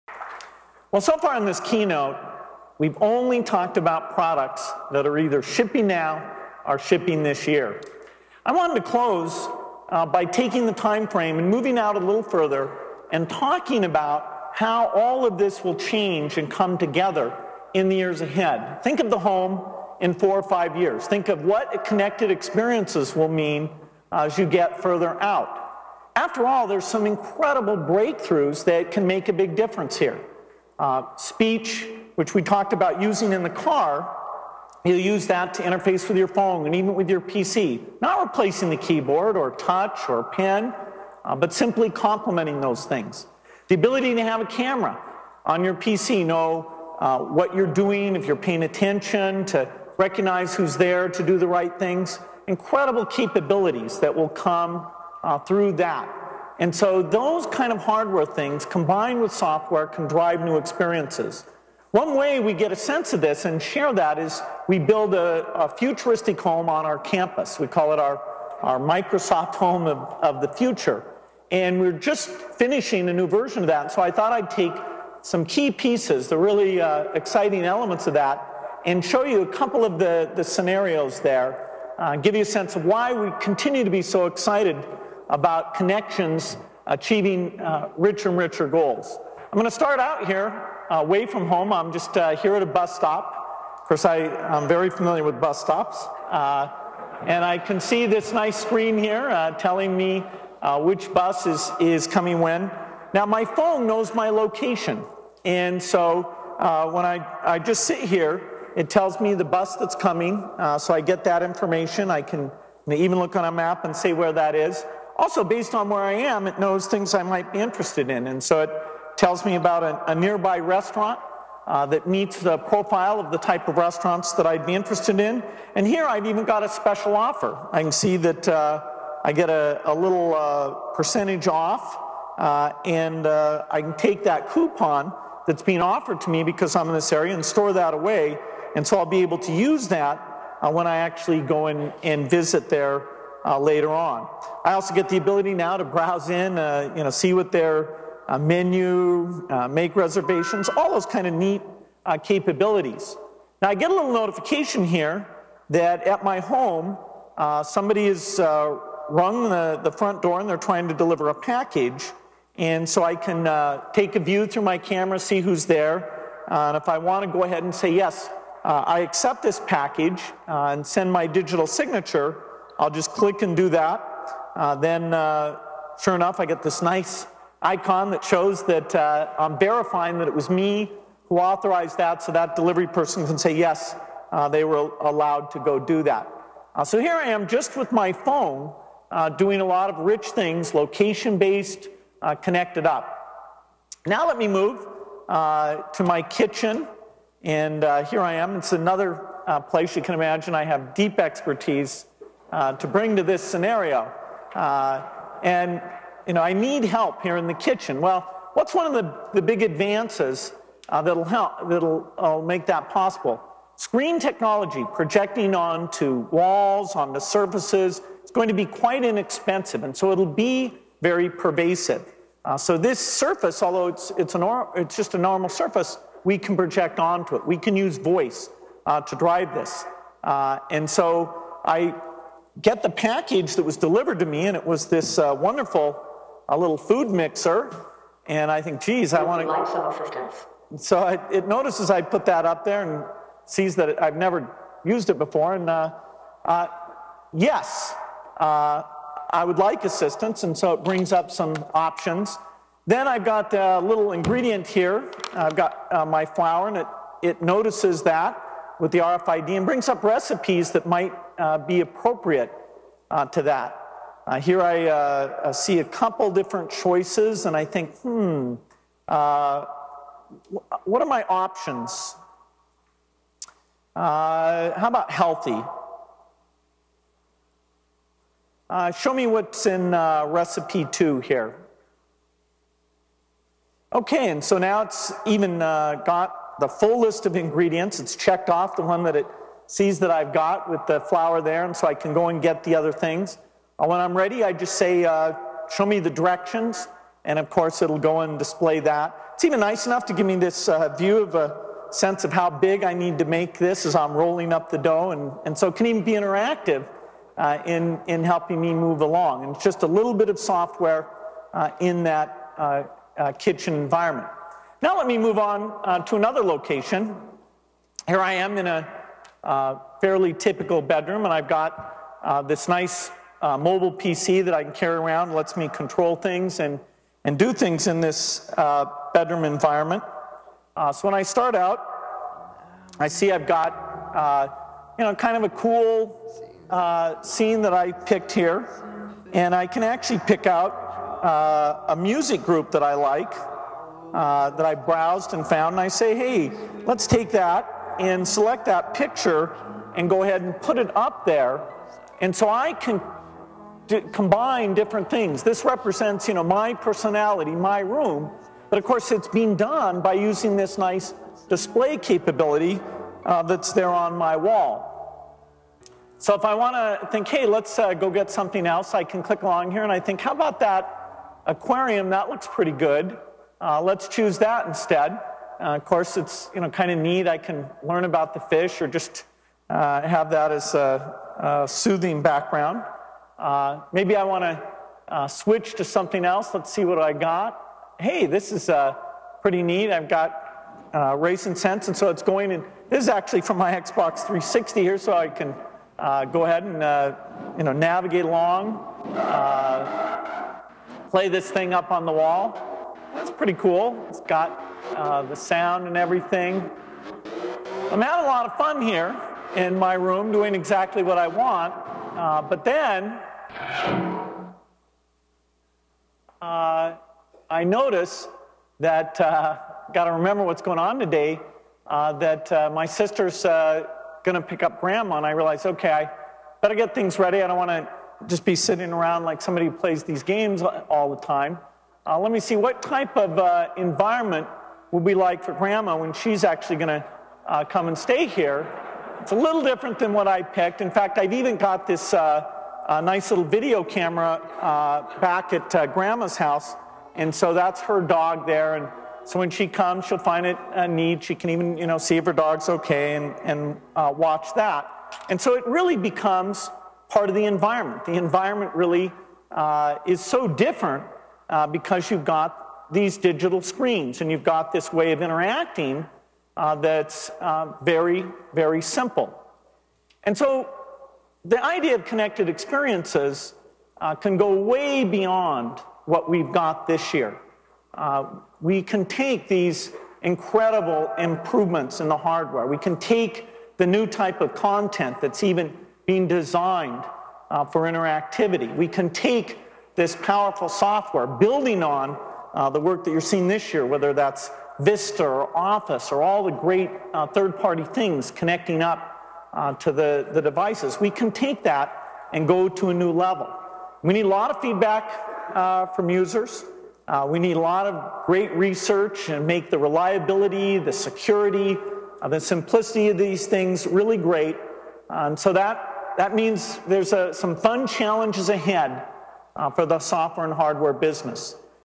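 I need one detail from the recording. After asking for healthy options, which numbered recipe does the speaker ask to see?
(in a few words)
Recipe 2.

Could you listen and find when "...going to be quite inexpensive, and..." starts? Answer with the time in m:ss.
3:38.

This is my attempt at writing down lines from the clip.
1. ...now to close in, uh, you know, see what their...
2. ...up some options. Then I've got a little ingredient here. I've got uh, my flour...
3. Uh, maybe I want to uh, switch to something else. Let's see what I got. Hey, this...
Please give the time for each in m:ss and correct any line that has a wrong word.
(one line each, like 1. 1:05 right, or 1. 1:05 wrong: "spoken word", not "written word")
1. 2:25 wrong: "browse", not "close"
2. 4:11 right
3. 6:23 right.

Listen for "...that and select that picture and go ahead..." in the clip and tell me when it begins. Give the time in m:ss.
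5:47.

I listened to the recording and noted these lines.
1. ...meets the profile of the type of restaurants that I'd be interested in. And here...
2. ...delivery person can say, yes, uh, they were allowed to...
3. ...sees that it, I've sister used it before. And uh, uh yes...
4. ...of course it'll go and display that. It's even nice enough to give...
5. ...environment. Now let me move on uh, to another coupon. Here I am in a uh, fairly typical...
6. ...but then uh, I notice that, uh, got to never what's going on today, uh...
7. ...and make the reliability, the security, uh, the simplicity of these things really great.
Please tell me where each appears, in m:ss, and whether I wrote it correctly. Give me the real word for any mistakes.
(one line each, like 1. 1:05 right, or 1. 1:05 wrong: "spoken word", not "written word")
1. 2:02 right
2. 3:02 right
3. 4:03 wrong: "never", not "sister"
4. 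4:57 right
5. 5:13 wrong: "location", not "coupon"
6. 6:52 wrong: "remember", not "never"
7. 8:29 right.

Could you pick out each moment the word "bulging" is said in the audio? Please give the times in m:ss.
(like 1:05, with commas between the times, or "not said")
not said.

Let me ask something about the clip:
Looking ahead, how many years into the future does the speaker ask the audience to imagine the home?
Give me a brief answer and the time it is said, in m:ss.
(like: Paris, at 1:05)
4 or 5, at 0:20.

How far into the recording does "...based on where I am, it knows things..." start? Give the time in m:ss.
1:55.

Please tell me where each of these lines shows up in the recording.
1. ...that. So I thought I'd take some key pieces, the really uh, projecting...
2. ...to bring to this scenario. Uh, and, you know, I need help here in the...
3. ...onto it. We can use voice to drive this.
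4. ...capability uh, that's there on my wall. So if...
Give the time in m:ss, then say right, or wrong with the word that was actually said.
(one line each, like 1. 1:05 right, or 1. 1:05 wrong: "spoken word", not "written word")
1. 1:13 wrong: "exciting", not "projecting"
2. 3:22 right
3. 3:46 right
4. 6:01 right.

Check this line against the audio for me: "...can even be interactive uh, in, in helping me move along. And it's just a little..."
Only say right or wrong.
right.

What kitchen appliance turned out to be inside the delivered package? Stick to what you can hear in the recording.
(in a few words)
Food mixer.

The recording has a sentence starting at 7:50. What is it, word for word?
And so the idea of connected experiences uh, can go way beyond what we've got this year.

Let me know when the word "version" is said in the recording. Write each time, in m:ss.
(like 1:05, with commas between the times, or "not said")
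1:13.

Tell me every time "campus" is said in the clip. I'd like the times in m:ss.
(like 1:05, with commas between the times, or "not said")
1:06.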